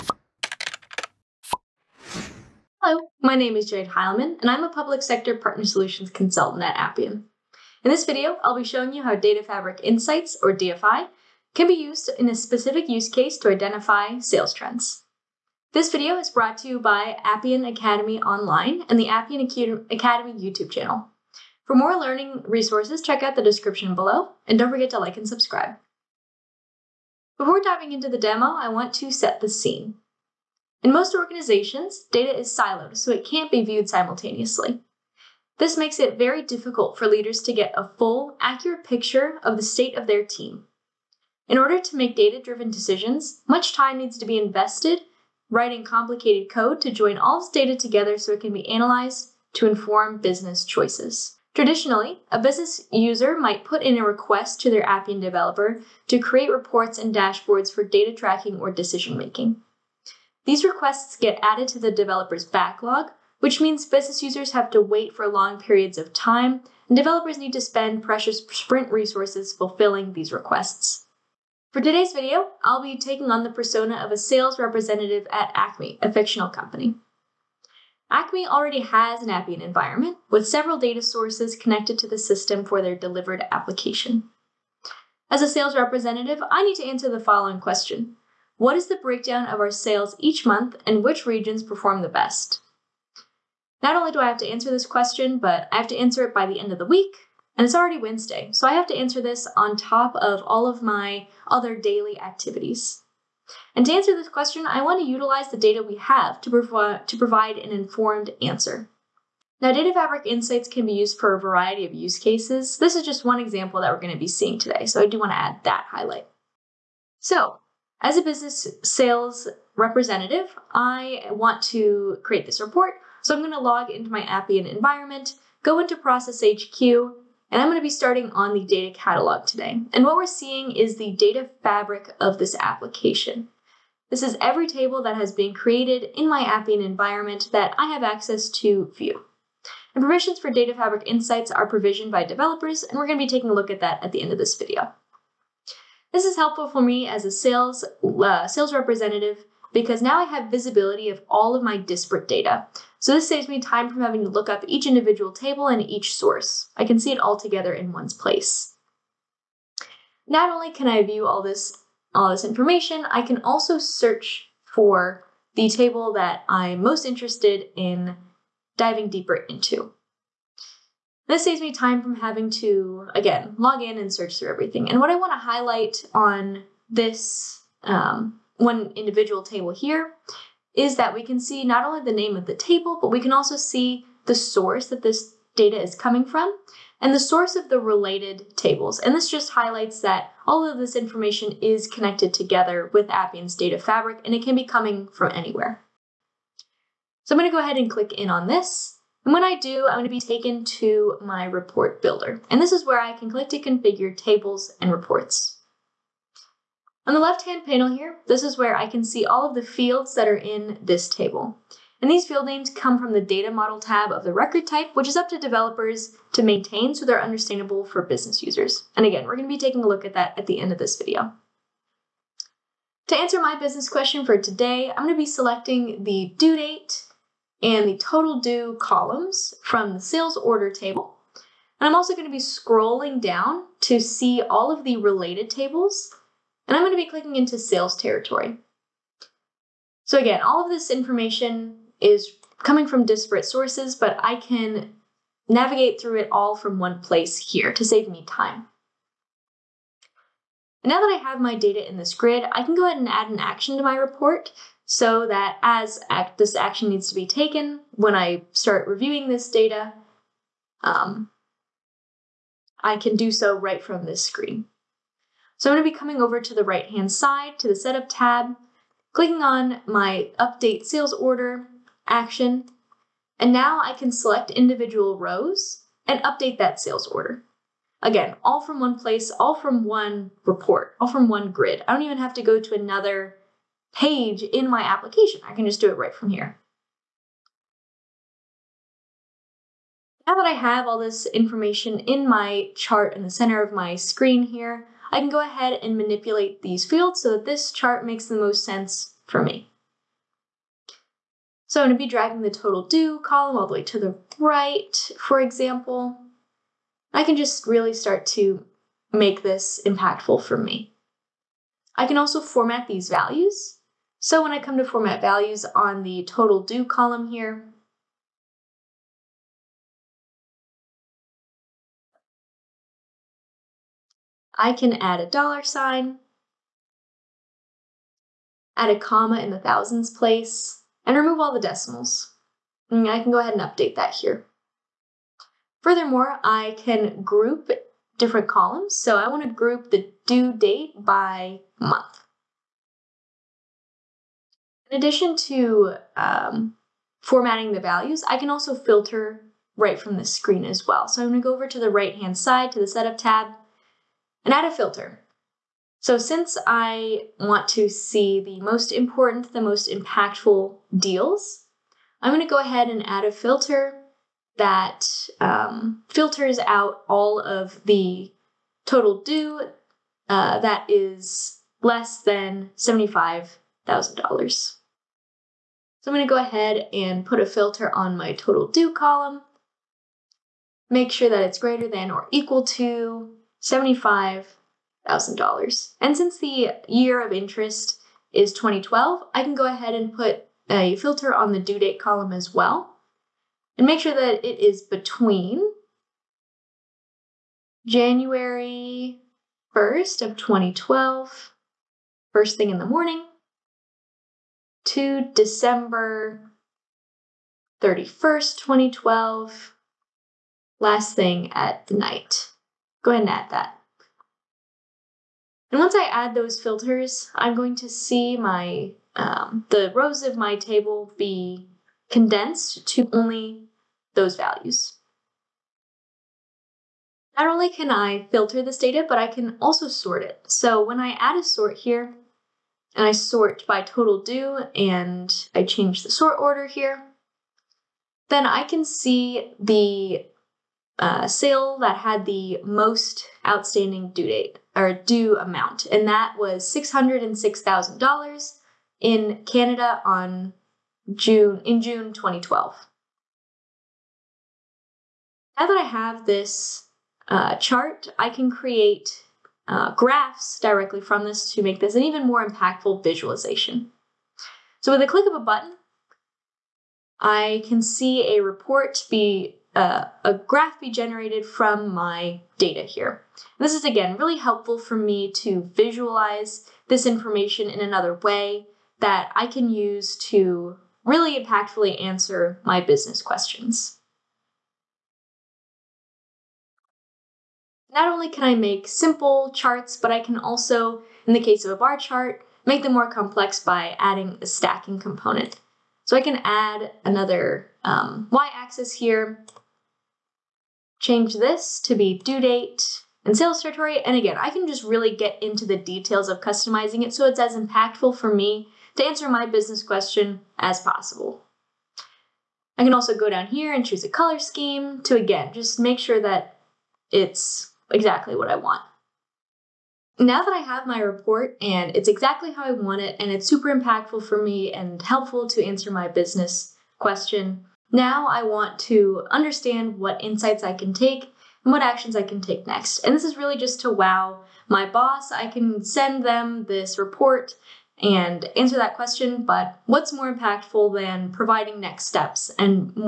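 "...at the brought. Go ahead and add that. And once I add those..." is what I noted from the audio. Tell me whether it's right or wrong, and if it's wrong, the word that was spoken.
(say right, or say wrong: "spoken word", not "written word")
wrong: "night", not "brought".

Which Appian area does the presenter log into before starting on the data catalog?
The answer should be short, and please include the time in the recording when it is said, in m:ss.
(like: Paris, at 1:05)
Process HQ, at 2:05.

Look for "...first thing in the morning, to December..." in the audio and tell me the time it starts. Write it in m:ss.
6:42.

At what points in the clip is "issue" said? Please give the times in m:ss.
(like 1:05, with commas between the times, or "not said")
not said.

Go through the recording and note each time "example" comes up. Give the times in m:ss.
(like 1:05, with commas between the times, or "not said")
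1:53, 5:05.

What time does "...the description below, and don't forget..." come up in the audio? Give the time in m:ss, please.
0:23.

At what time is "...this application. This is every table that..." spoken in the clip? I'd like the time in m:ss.
2:12.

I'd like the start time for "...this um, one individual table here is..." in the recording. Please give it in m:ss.
2:56.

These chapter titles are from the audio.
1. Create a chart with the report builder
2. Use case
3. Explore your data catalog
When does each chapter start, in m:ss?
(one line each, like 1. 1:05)
1. 3:20
2. 0:30
3. 1:57.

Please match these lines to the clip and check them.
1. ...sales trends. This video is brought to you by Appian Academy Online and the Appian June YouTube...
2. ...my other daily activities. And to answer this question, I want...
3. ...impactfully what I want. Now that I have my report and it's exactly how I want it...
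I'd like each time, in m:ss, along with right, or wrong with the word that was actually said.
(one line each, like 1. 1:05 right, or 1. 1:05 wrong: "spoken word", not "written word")
1. 0:14 wrong: "Academy", not "June"
2. 1:40 right
3. 8:37 wrong: "exactly", not "impactfully".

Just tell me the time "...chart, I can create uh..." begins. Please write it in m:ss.
7:37.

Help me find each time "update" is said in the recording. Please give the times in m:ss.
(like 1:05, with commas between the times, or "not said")
4:30, 4:36, 5:33.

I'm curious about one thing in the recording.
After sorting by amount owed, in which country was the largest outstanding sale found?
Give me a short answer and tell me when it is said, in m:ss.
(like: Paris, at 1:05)
Canada, at 7:29.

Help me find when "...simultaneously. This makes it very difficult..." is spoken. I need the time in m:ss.
0:33.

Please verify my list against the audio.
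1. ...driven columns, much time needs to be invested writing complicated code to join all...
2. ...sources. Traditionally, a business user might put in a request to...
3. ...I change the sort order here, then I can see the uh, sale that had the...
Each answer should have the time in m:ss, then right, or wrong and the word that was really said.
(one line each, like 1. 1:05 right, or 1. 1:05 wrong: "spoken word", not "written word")
1. 0:42 wrong: "decisions", not "columns"
2. 0:50 wrong: "choices", not "sources"
3. 7:15 right.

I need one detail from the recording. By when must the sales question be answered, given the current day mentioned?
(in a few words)
End of the week.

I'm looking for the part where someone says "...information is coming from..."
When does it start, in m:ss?
4:00.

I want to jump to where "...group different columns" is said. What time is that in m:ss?
5:37.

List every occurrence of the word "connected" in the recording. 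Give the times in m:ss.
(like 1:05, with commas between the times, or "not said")
1:21, 3:11.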